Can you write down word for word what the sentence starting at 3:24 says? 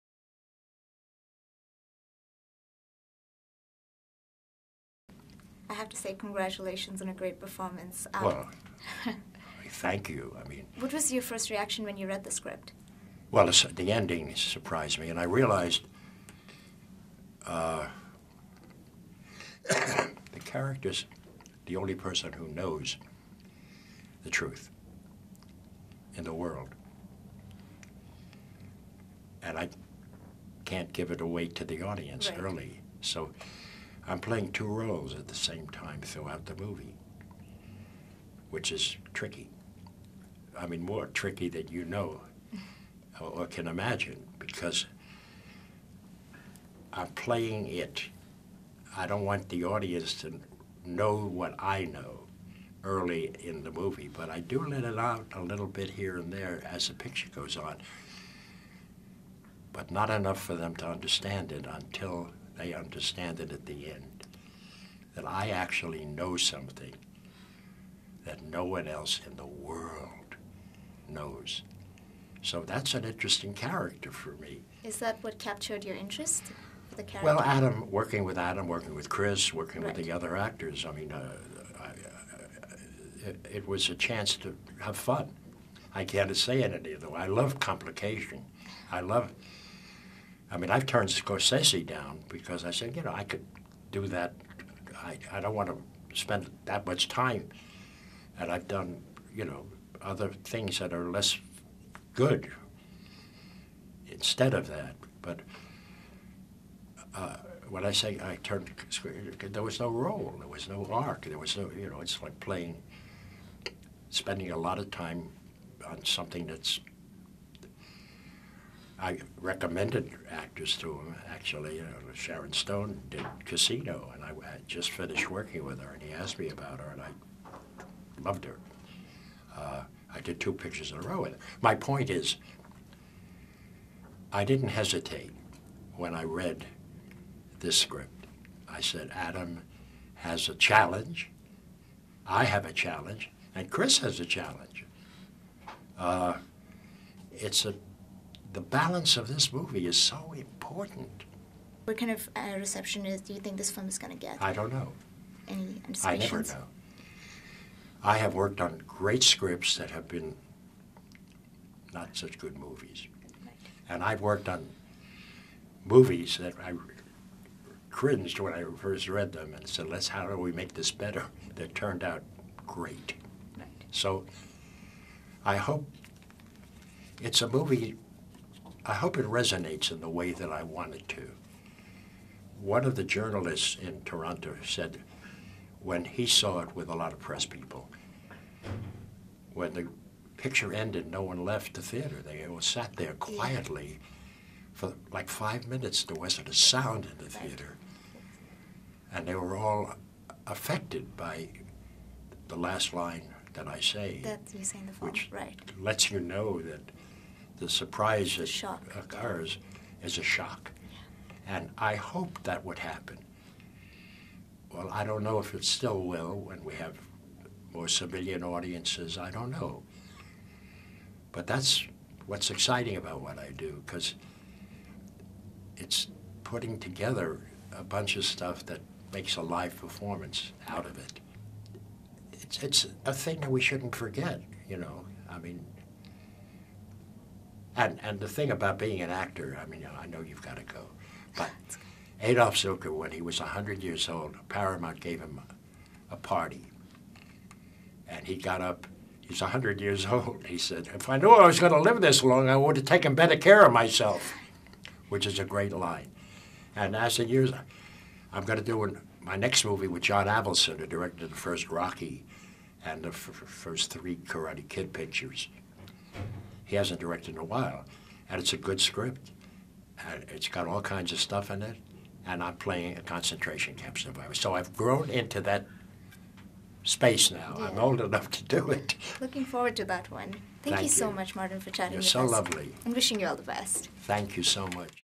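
That you say in the film, which lets you know that the surprise that shock.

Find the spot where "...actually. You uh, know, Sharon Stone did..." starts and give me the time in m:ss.
2:01.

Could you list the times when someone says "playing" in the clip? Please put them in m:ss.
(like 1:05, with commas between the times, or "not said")
0:34, 0:47, 1:52, 4:32.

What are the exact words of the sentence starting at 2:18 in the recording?
I said, Atom has a challenge, I have a challenge, and Chris has a challenge.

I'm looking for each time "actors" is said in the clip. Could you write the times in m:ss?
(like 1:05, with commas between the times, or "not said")
1:20, 2:00, 3:59.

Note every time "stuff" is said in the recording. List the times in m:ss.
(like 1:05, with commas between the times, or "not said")
3:48, 4:31.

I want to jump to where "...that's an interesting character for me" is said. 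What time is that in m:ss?
1:12.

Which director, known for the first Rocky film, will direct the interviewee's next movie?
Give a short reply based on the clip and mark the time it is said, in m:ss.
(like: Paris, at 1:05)
John Avildsen, at 4:20.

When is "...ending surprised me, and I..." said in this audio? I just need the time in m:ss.
0:13.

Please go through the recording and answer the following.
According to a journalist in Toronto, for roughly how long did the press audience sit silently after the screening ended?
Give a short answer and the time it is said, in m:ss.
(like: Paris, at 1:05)
5 minutes, at 3:15.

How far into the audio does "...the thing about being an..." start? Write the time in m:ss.
3:58.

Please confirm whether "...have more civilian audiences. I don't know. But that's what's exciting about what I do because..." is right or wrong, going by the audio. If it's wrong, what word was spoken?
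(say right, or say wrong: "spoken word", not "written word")
right.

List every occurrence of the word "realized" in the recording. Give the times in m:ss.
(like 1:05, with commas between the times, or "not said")
0:15.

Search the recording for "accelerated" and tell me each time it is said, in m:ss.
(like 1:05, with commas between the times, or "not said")
not said.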